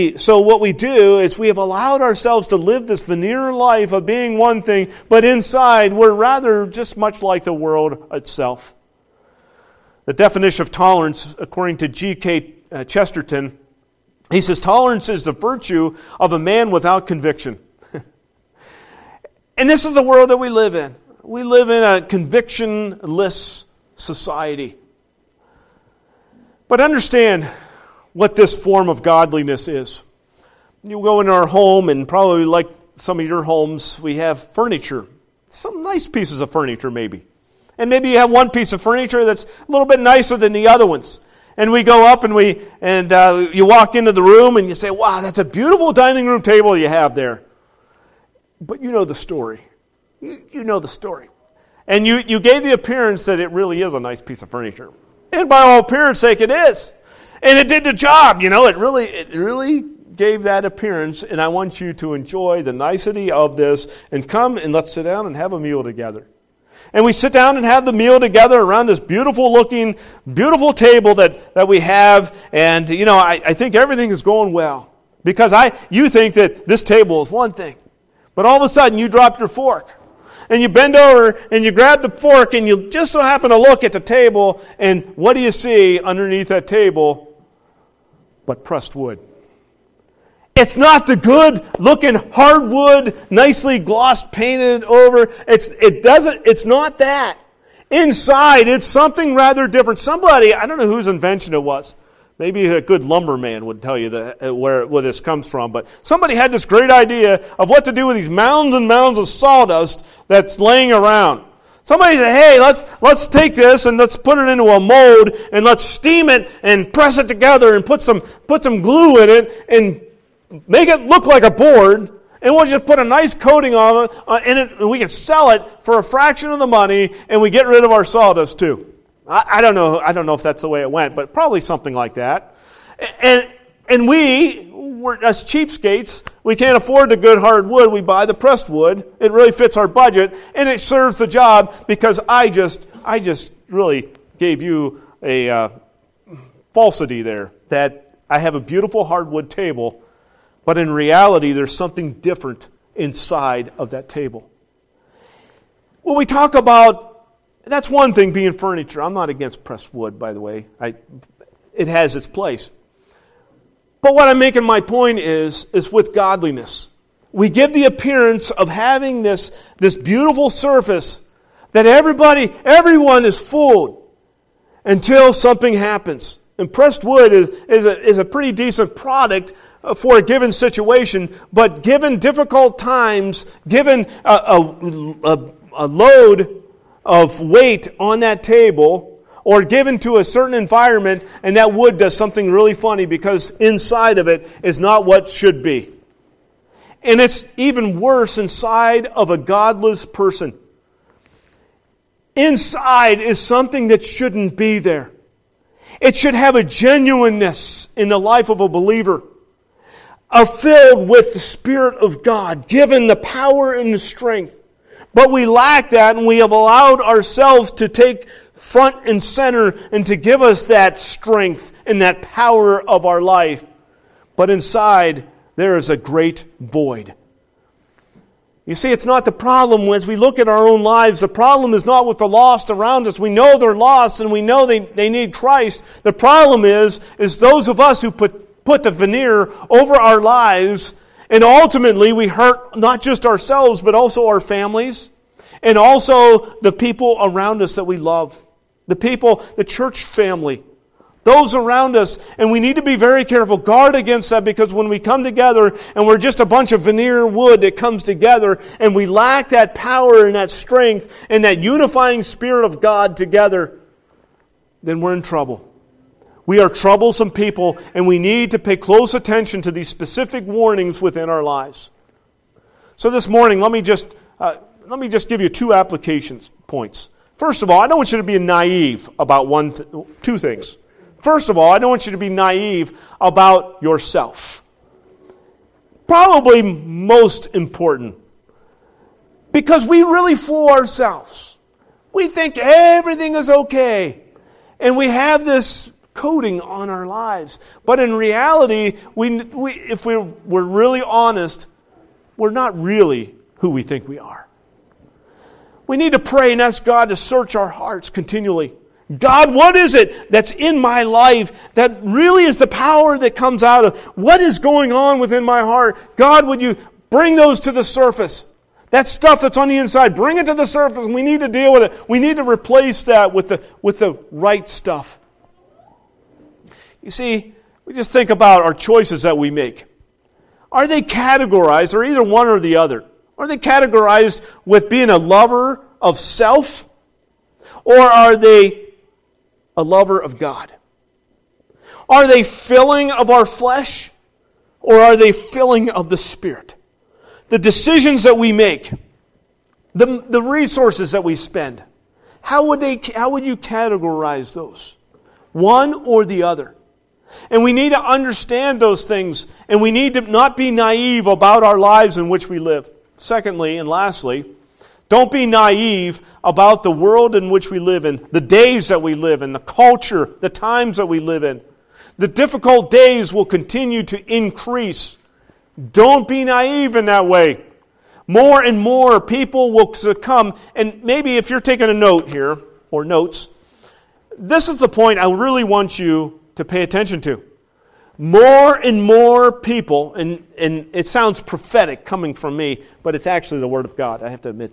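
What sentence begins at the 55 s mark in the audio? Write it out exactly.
And by all appearance sake, it is and it did the job.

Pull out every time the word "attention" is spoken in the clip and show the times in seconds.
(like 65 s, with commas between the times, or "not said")
269 s, 386 s.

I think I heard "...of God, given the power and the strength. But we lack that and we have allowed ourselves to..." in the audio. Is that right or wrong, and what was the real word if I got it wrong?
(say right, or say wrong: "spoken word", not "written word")
right.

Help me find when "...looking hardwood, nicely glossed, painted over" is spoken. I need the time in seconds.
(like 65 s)
91 s.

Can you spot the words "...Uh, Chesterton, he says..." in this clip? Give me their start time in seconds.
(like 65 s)
12 s.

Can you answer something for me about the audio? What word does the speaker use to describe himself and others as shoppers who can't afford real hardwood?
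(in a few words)
Cheapskates.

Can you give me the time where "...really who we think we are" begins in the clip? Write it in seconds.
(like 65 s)
302 s.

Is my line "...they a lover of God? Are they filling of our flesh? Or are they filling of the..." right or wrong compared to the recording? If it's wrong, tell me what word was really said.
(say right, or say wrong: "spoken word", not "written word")
right.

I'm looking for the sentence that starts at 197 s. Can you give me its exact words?
And it's even worse inside of a godless person.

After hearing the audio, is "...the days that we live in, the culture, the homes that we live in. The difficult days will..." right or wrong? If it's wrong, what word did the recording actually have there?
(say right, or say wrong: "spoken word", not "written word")
wrong: "times", not "homes".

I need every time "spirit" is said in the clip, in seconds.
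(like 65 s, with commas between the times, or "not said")
211 s, 262 s, 346 s.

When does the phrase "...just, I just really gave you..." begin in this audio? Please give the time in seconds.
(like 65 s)
142 s.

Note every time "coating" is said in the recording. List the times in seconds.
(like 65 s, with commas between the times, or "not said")
123 s, 296 s.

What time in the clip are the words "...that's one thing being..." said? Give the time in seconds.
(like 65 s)
157 s.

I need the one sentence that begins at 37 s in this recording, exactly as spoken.
And maybe you have one piece of furniture that's a little bit nicer than the other ones.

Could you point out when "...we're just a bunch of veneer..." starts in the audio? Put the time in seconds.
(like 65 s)
256 s.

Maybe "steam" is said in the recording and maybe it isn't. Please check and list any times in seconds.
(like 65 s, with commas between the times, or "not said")
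115 s.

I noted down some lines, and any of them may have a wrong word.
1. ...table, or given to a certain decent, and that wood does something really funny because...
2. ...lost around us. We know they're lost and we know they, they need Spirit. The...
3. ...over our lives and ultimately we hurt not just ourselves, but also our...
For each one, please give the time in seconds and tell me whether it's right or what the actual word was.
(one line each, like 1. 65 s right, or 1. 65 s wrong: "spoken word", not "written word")
1. 188 s wrong: "environment", not "decent"
2. 232 s wrong: "Christ", not "Spirit"
3. 239 s right.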